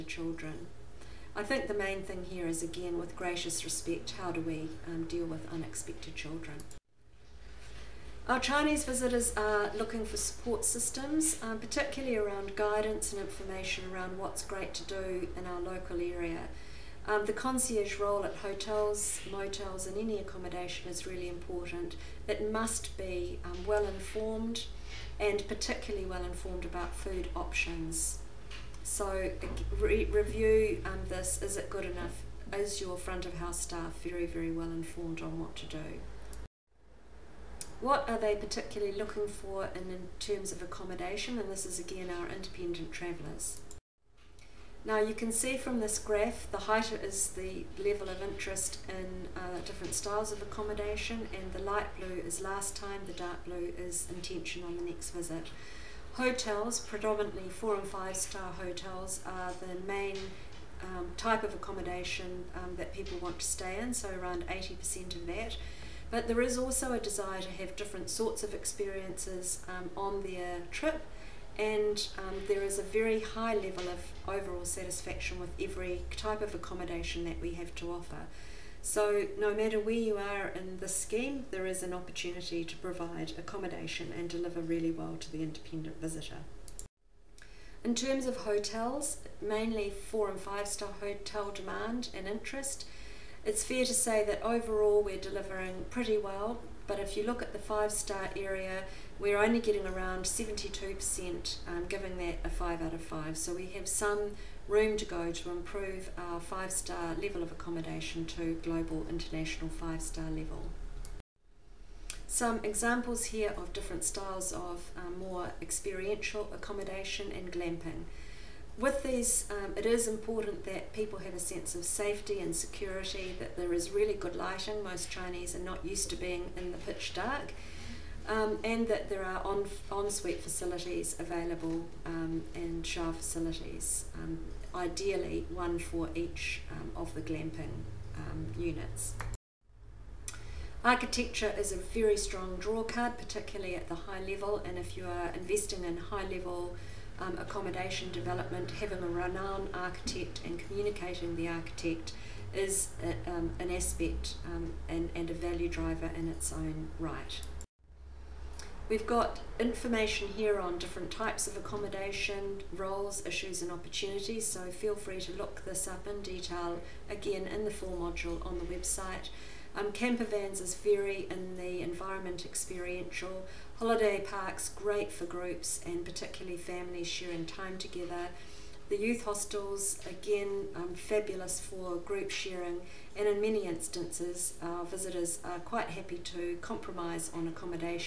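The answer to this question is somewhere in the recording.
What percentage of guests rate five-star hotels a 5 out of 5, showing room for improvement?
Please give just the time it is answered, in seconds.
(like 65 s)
100 s.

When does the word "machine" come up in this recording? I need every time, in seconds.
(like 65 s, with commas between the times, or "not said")
not said.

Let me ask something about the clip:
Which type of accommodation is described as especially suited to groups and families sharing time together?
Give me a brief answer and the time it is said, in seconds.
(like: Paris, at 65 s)
Holiday parks, at 173 s.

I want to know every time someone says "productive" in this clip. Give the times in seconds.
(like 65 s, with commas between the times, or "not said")
not said.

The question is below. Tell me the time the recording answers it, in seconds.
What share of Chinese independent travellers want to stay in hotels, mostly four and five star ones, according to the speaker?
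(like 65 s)
64 s.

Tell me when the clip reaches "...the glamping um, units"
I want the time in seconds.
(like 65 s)
137 s.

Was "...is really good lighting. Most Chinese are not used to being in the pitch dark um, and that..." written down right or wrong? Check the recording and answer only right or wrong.
right.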